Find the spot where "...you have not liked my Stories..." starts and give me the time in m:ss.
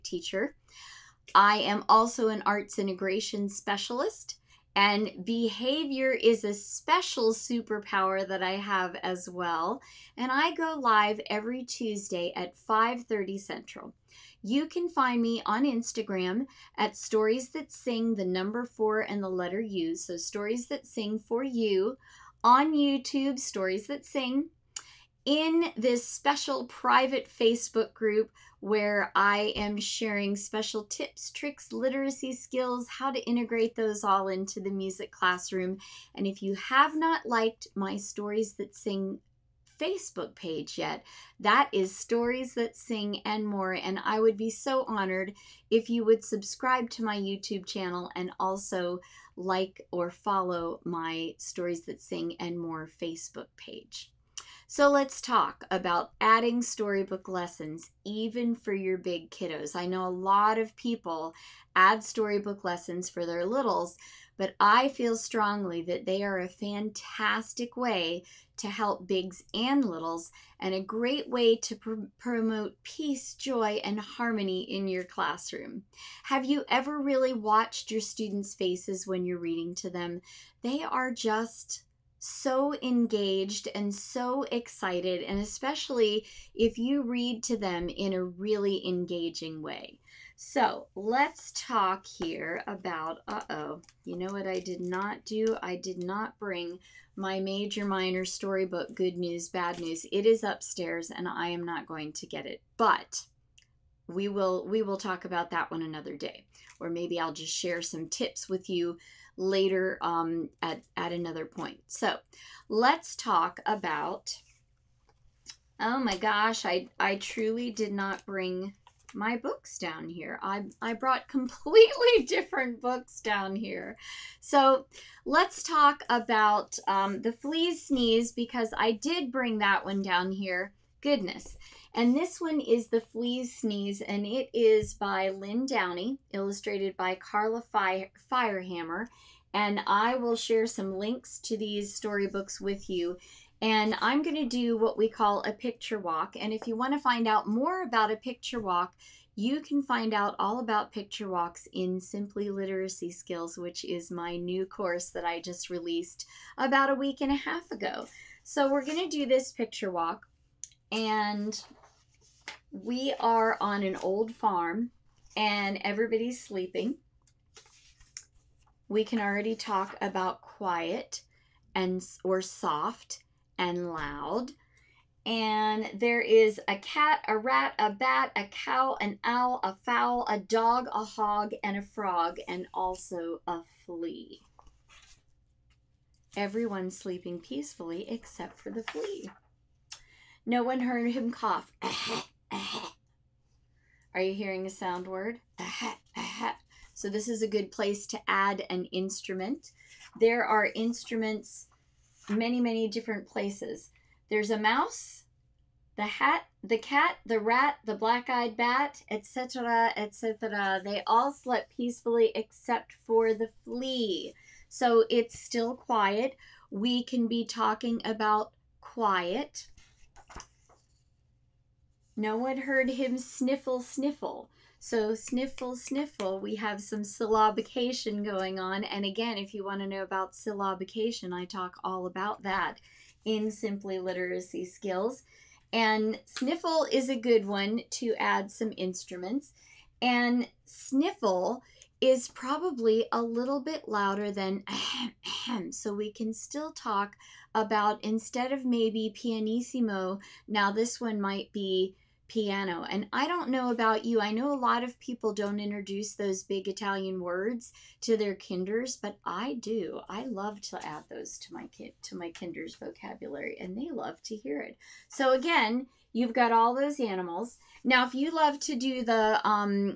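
0:36.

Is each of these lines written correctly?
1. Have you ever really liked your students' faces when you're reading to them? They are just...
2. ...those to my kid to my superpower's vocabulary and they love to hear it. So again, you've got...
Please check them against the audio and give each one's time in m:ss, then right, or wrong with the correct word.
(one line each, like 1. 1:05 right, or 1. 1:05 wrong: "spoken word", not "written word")
1. 1:16 wrong: "watched", not "liked"
2. 4:21 wrong: "kinder", not "superpower".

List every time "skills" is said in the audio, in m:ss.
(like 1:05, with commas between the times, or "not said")
0:32, 2:33, 3:54.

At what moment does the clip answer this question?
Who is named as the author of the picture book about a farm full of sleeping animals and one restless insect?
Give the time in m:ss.
2:15.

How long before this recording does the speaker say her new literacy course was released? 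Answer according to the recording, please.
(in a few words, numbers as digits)
a week and a half.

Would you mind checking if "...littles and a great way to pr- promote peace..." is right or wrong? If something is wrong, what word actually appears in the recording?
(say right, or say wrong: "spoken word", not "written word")
right.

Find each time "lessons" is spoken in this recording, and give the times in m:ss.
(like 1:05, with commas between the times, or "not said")
0:57, 1:02.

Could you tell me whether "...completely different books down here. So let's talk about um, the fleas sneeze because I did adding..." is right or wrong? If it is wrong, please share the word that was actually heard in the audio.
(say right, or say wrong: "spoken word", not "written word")
wrong: "bring", not "adding".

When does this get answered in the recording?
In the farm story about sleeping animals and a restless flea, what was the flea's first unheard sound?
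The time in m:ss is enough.
3:11.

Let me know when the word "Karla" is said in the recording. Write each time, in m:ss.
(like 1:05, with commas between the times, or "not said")
2:17.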